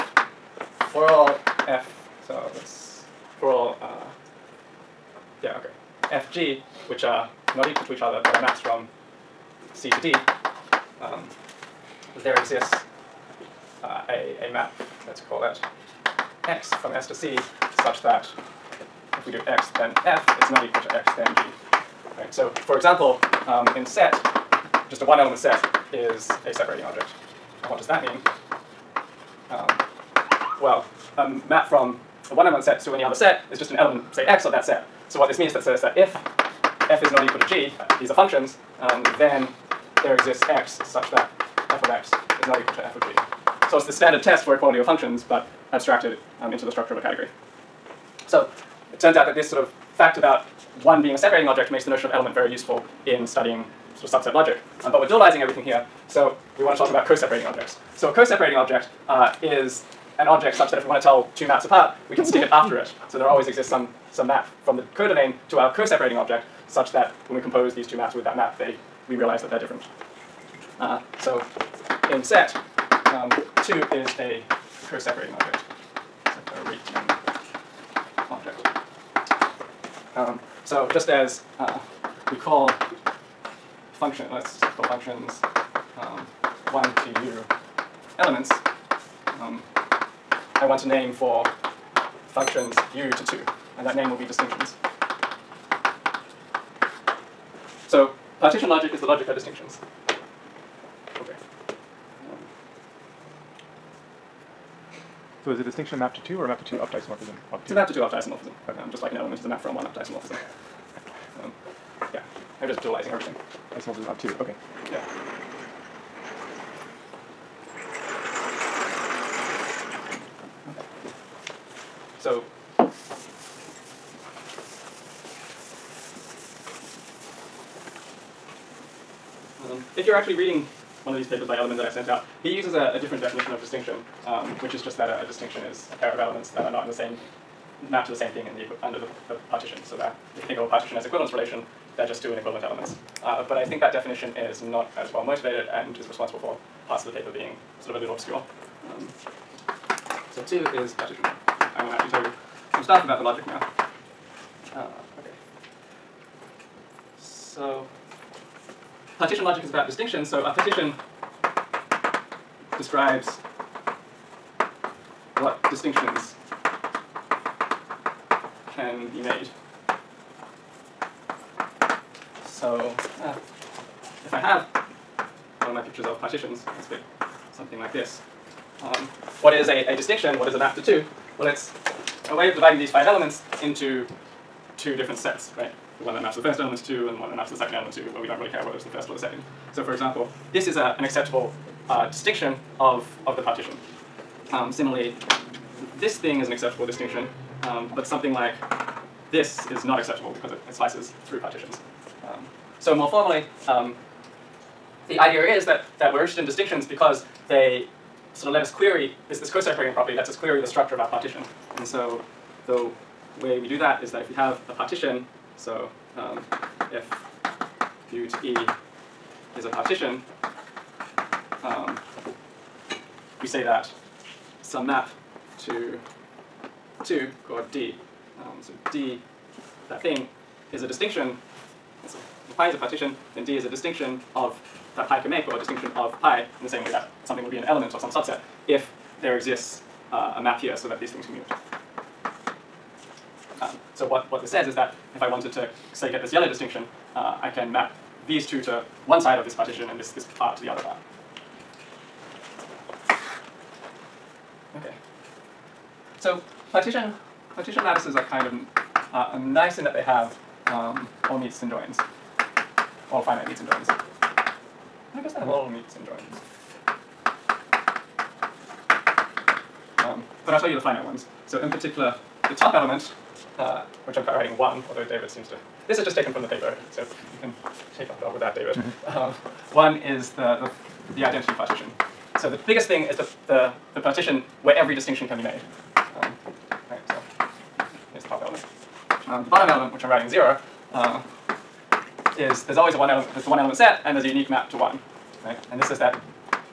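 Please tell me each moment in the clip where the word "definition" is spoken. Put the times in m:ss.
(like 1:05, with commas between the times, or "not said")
2:13, 2:23.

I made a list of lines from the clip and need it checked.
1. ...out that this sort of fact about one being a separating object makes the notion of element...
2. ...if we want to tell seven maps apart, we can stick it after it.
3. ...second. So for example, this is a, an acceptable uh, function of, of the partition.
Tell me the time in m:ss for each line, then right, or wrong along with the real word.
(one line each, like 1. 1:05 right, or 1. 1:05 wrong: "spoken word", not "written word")
1. 0:49 right
2. 1:00 wrong: "two", not "seven"
3. 3:09 wrong: "distinction", not "function".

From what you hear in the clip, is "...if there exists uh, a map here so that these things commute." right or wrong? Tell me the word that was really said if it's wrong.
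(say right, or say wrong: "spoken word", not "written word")
right.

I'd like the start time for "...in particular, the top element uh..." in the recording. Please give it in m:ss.
4:31.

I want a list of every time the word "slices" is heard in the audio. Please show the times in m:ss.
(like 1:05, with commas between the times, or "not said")
3:20.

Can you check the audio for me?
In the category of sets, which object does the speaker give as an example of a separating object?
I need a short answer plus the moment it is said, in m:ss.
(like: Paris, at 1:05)
a one element set, at 0:24.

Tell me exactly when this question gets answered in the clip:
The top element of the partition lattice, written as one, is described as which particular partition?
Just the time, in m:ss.
4:41.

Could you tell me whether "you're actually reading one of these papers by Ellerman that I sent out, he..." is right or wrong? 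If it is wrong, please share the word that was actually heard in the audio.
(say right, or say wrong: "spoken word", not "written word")
right.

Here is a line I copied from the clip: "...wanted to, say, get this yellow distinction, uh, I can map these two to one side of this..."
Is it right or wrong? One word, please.
right.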